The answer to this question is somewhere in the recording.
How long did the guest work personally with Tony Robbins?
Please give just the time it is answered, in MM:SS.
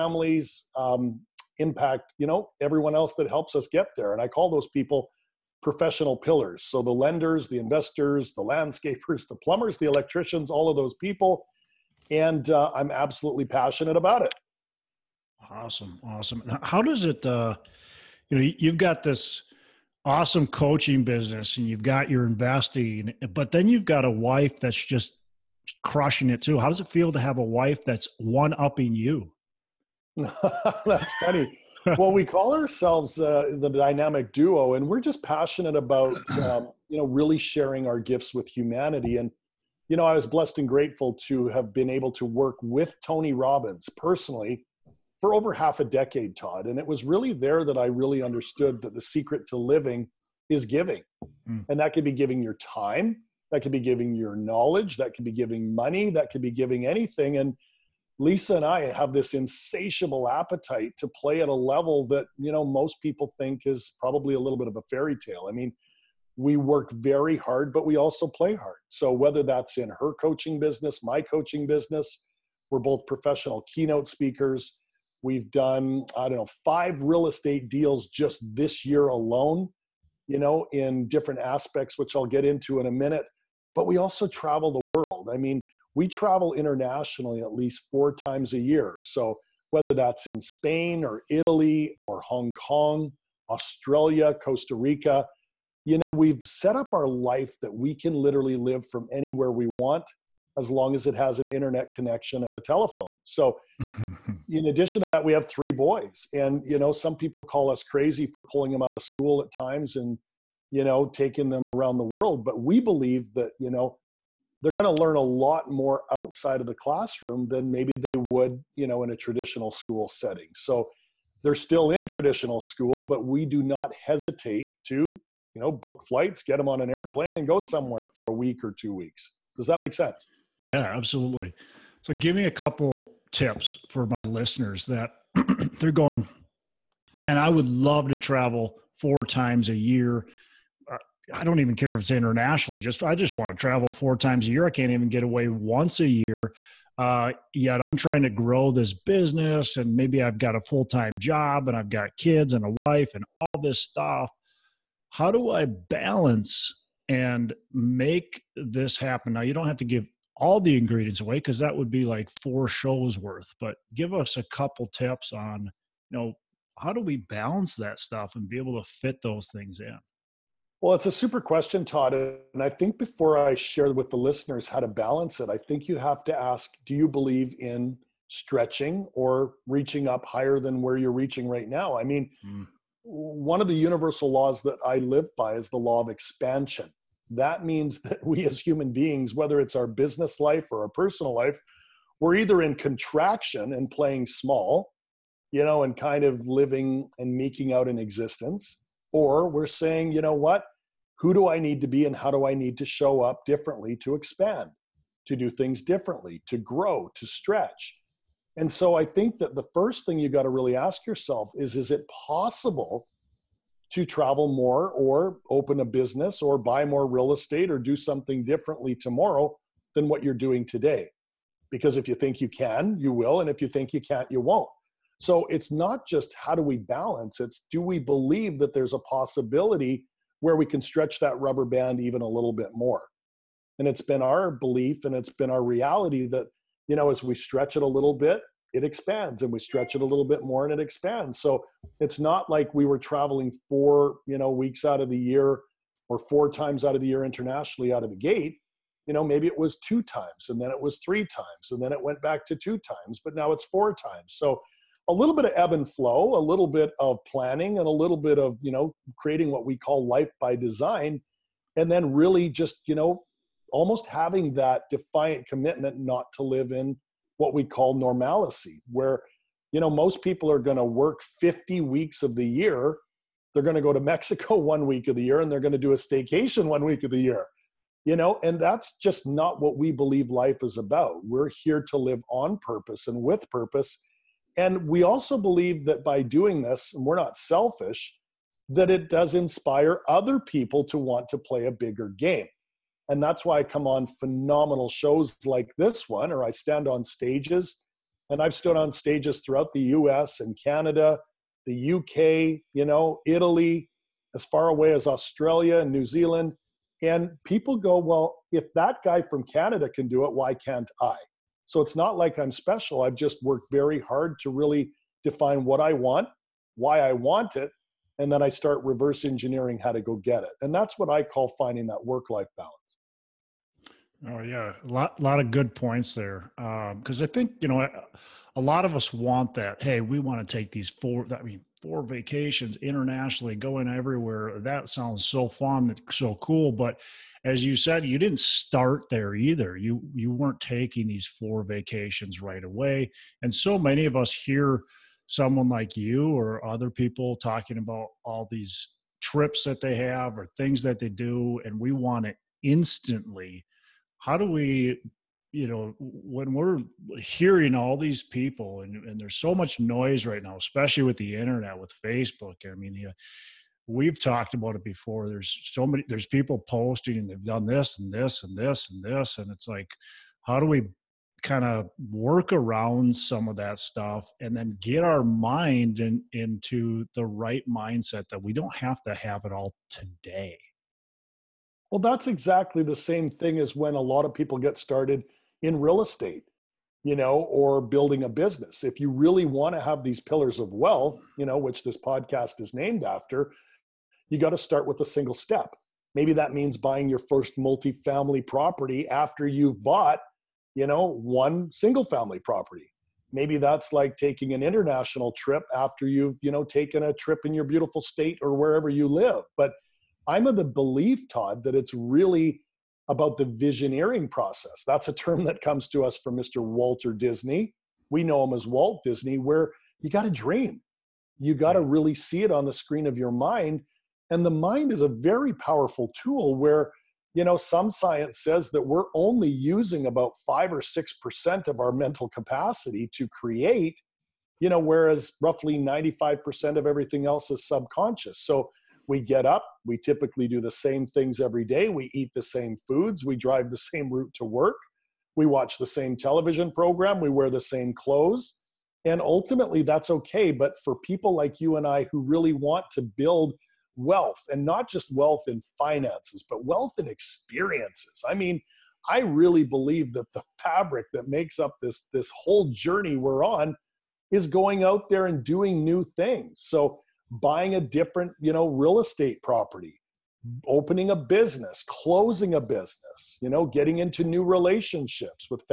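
00:45.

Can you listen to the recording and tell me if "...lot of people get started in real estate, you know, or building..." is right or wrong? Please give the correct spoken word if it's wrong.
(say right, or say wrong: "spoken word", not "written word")
right.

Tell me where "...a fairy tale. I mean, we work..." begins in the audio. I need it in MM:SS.
01:04.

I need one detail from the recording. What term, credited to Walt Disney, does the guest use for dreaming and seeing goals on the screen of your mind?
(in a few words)
visioneering.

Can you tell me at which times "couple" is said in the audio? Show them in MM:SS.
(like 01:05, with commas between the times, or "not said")
02:12, 02:44.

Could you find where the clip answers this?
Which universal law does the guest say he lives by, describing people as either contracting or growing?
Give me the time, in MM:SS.
03:05.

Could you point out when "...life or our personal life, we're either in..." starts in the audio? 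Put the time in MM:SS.
03:10.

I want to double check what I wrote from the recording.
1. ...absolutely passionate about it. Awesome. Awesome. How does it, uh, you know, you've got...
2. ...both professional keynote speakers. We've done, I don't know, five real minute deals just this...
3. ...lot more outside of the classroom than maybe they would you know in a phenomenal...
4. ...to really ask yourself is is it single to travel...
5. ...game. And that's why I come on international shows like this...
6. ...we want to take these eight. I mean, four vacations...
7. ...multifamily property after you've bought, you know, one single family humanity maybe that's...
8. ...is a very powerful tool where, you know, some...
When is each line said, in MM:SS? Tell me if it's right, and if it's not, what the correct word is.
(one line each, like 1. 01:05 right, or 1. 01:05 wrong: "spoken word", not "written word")
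1. 00:12 right
2. 01:12 wrong: "estate", not "minute"
3. 01:55 wrong: "traditional", not "phenomenal"
4. 03:30 wrong: "possible", not "single"
5. 04:52 wrong: "phenomenal", not "international"
6. 05:30 wrong: "four", not "eight"
7. 06:37 wrong: "property", not "humanity"
8. 07:04 right.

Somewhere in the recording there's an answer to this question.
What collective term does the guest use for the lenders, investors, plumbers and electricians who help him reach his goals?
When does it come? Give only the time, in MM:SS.
00:05.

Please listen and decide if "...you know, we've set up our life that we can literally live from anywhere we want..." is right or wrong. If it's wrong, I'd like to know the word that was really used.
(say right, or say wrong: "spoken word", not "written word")
right.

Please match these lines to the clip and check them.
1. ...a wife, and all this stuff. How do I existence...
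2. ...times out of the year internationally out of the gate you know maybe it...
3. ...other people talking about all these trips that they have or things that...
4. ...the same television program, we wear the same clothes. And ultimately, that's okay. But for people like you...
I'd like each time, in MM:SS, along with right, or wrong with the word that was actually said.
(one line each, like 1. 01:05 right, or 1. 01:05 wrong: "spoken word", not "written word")
1. 02:32 wrong: "balance", not "existence"
2. 04:06 right
3. 05:46 right
4. 07:25 right.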